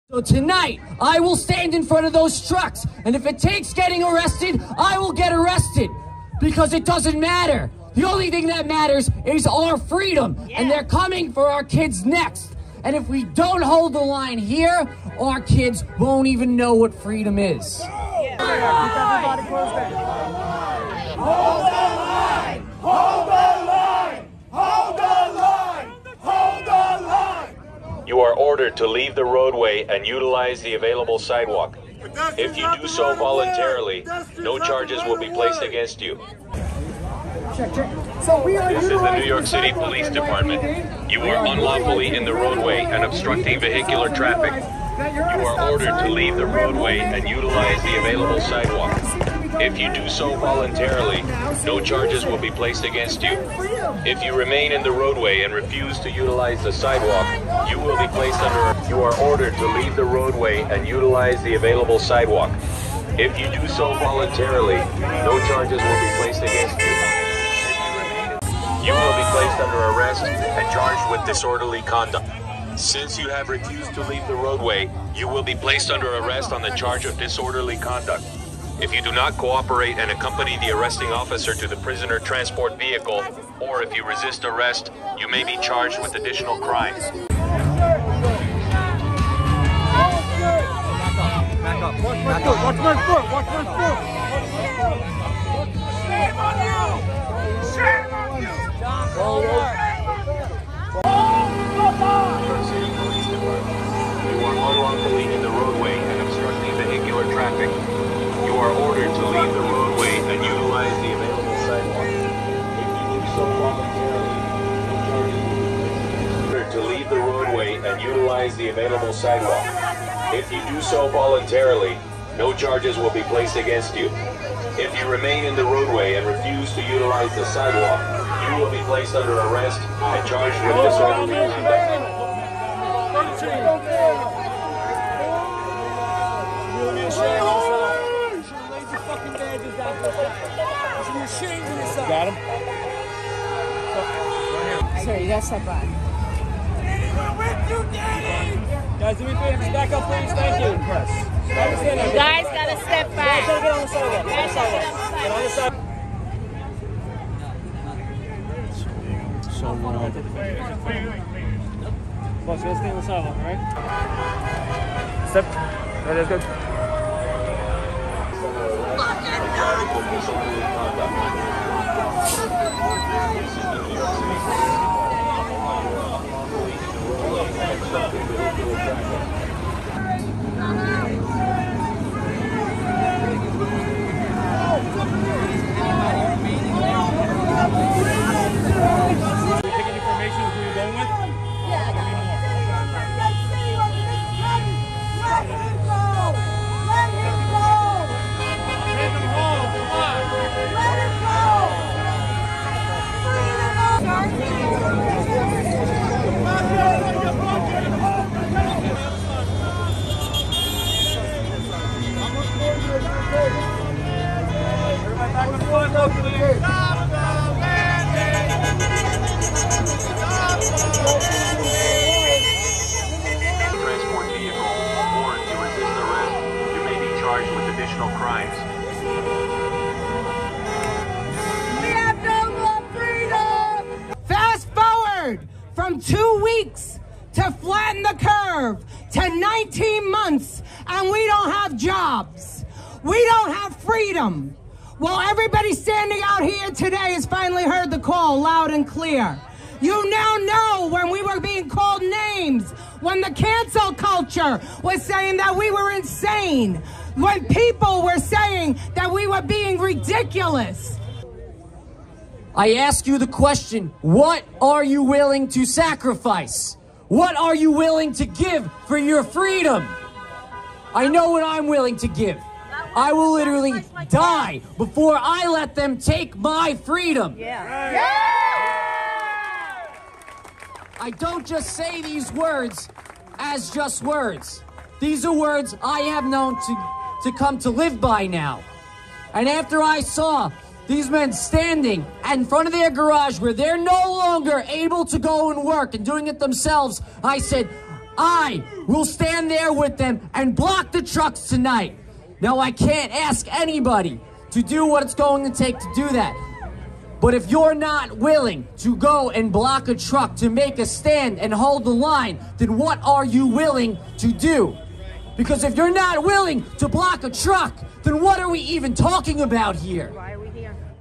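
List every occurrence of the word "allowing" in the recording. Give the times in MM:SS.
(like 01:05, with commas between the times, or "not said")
not said.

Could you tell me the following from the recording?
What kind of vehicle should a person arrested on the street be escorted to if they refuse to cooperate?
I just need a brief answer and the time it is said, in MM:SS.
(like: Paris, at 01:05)
Prisoner transport vehicle, at 01:21.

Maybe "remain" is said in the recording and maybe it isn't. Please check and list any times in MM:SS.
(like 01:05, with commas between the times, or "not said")
00:54, 02:05.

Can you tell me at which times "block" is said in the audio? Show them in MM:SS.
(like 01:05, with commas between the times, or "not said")
05:00, 05:09, 05:16.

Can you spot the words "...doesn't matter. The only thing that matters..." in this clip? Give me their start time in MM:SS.
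00:06.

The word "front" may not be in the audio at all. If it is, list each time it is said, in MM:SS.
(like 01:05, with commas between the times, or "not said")
00:01, 04:52.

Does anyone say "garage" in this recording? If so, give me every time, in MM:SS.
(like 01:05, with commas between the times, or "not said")
04:52.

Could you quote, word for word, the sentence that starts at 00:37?
this is the New York City Police Department.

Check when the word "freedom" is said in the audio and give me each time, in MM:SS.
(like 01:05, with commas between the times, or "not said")
00:09, 00:16, 04:29, 04:36.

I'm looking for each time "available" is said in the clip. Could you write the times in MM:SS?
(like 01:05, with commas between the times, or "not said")
00:30, 00:47, 01:01, 01:58.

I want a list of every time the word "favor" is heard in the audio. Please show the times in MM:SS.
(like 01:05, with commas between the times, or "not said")
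02:29.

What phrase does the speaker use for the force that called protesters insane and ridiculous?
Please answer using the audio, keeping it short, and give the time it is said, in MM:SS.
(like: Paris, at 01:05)
Cancel culture, at 04:13.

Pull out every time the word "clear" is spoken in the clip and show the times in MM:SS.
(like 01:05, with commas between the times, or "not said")
04:08.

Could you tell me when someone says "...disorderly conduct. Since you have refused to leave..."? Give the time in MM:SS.
01:11.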